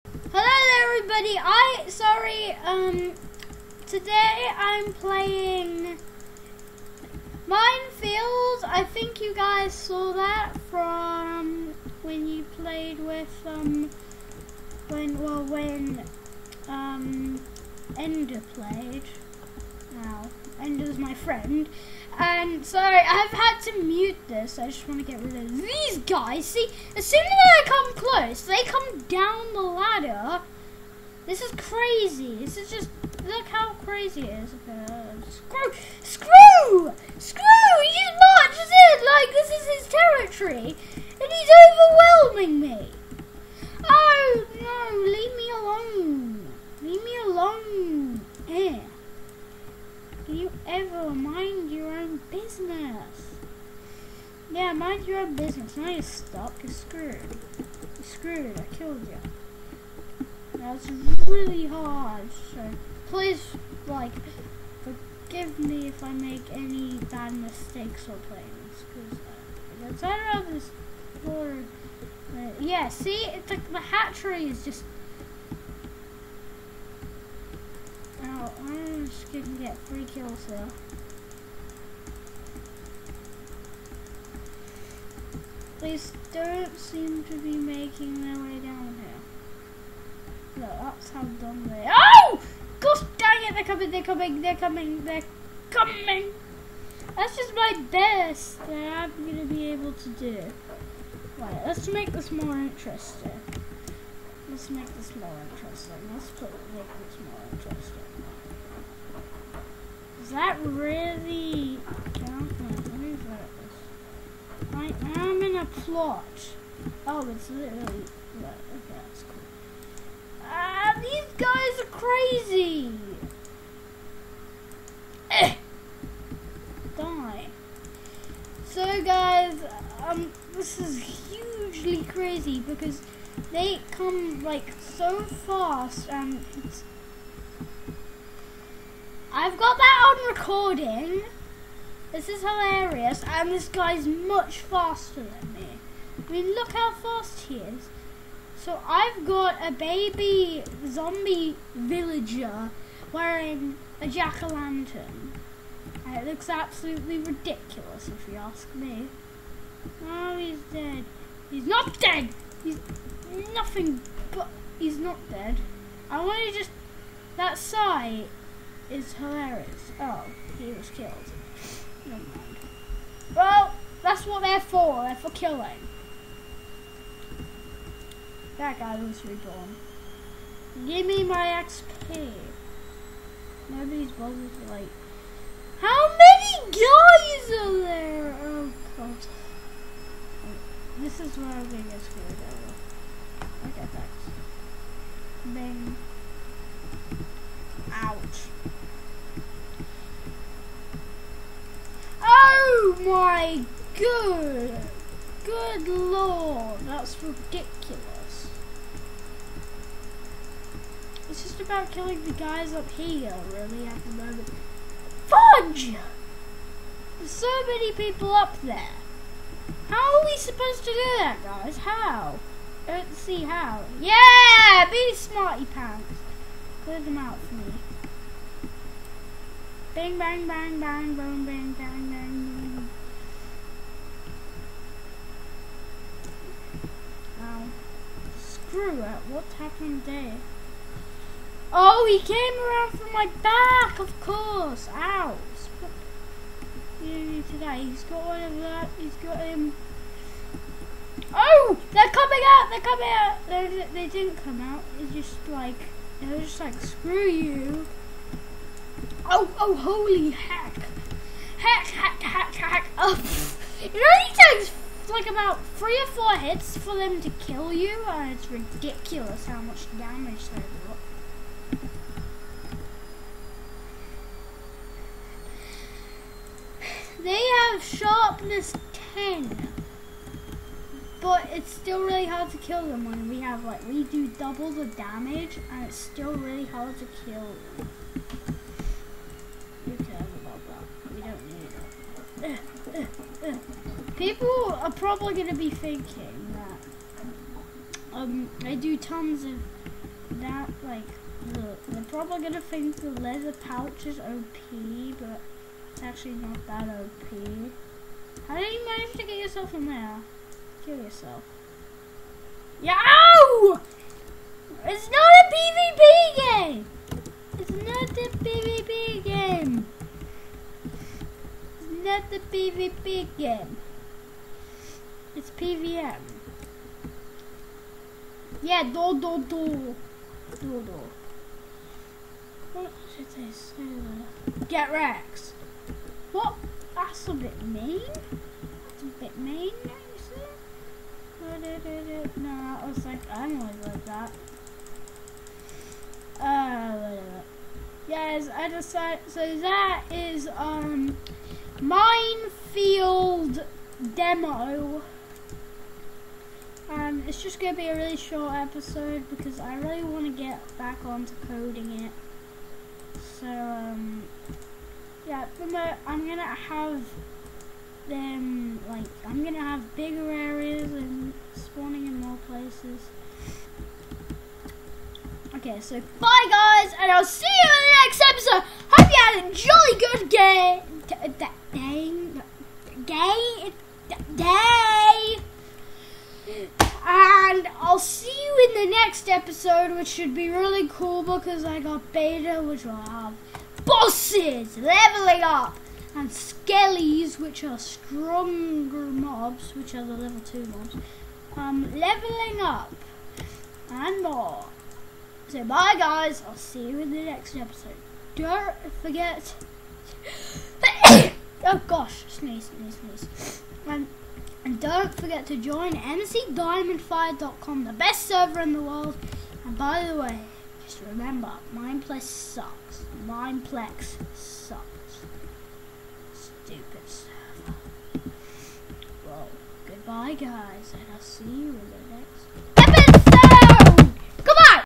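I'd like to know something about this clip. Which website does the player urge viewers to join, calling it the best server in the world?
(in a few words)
mcdiamondfire.com.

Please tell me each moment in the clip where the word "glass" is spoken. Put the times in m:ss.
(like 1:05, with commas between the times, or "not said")
not said.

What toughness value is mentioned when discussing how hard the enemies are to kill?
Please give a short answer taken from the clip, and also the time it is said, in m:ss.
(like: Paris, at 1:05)
10, at 4:38.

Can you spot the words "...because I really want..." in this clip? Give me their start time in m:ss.
5:59.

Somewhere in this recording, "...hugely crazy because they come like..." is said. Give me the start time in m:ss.
2:11.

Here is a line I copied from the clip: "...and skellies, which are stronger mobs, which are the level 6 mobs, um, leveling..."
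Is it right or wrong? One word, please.
wrong.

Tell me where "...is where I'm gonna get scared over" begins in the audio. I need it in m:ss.
3:11.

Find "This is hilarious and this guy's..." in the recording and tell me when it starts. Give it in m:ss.
2:22.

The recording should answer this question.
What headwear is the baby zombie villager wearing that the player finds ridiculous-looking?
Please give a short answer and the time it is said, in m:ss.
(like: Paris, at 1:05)
jack-o'-lantern, at 2:34.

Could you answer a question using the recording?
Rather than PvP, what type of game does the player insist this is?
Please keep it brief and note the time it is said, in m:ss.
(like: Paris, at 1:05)
PVM, at 5:25.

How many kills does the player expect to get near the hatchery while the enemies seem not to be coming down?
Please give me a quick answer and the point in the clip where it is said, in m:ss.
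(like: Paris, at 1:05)
3, at 1:19.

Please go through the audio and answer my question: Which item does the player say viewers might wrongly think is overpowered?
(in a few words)
leather pouch.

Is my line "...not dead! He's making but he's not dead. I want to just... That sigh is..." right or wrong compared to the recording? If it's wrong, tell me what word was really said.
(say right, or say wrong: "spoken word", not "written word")
wrong: "nothing", not "making".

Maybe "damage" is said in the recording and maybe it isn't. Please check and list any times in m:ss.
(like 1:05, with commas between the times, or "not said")
4:29, 4:44.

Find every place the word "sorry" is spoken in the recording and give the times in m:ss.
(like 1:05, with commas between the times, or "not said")
0:01, 0:22.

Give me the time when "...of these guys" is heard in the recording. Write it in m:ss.
0:25.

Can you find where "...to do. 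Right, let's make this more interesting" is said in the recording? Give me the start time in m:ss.
1:39.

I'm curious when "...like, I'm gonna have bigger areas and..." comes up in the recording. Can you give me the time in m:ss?
6:08.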